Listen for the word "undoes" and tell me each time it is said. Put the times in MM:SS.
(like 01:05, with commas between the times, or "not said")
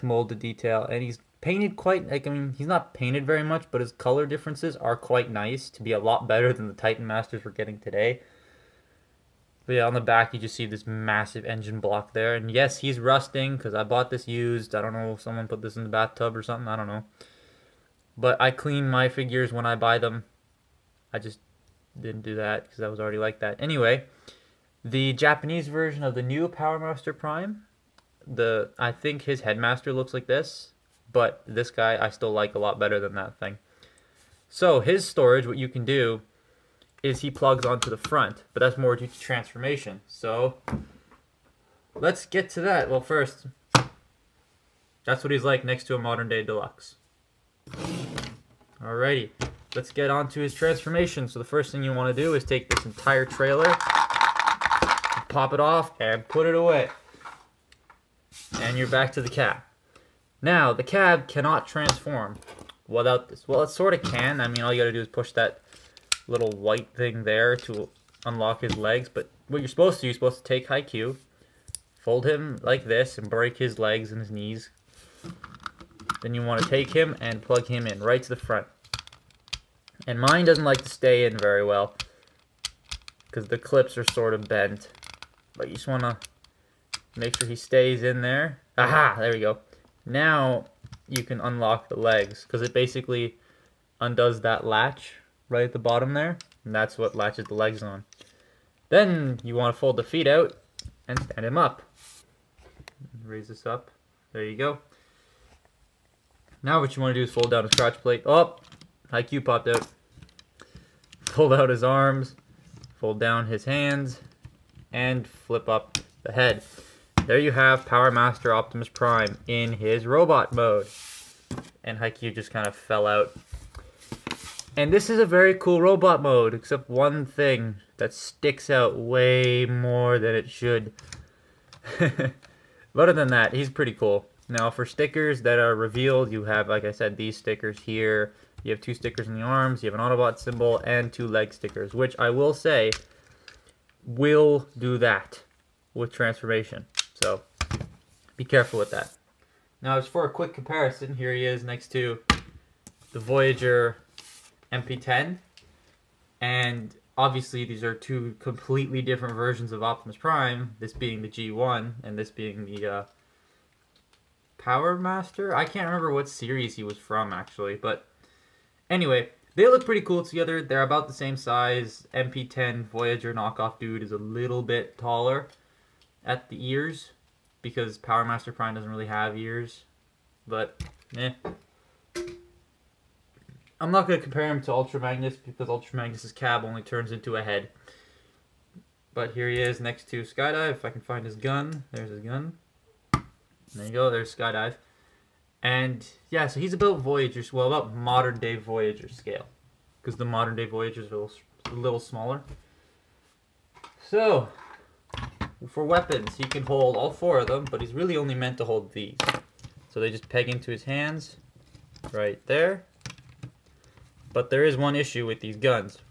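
01:33.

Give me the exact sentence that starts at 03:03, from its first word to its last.
I'm not going to compare him to Ultra Magnus because Ultra Magnus's cab only turns into a head.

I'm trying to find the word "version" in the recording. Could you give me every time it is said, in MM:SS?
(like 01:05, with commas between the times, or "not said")
00:25, 02:39.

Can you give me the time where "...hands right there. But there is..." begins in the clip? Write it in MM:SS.
03:30.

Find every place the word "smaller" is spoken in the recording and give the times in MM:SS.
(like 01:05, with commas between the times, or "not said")
03:21.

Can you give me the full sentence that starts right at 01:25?
But you just want to make sure he stays in there.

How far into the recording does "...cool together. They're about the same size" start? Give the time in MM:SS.
02:50.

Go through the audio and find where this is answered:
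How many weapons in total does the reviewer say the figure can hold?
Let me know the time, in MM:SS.
03:27.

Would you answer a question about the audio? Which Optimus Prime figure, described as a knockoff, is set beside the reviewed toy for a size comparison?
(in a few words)
Voyager MP10.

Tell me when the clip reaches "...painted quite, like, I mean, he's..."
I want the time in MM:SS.
00:01.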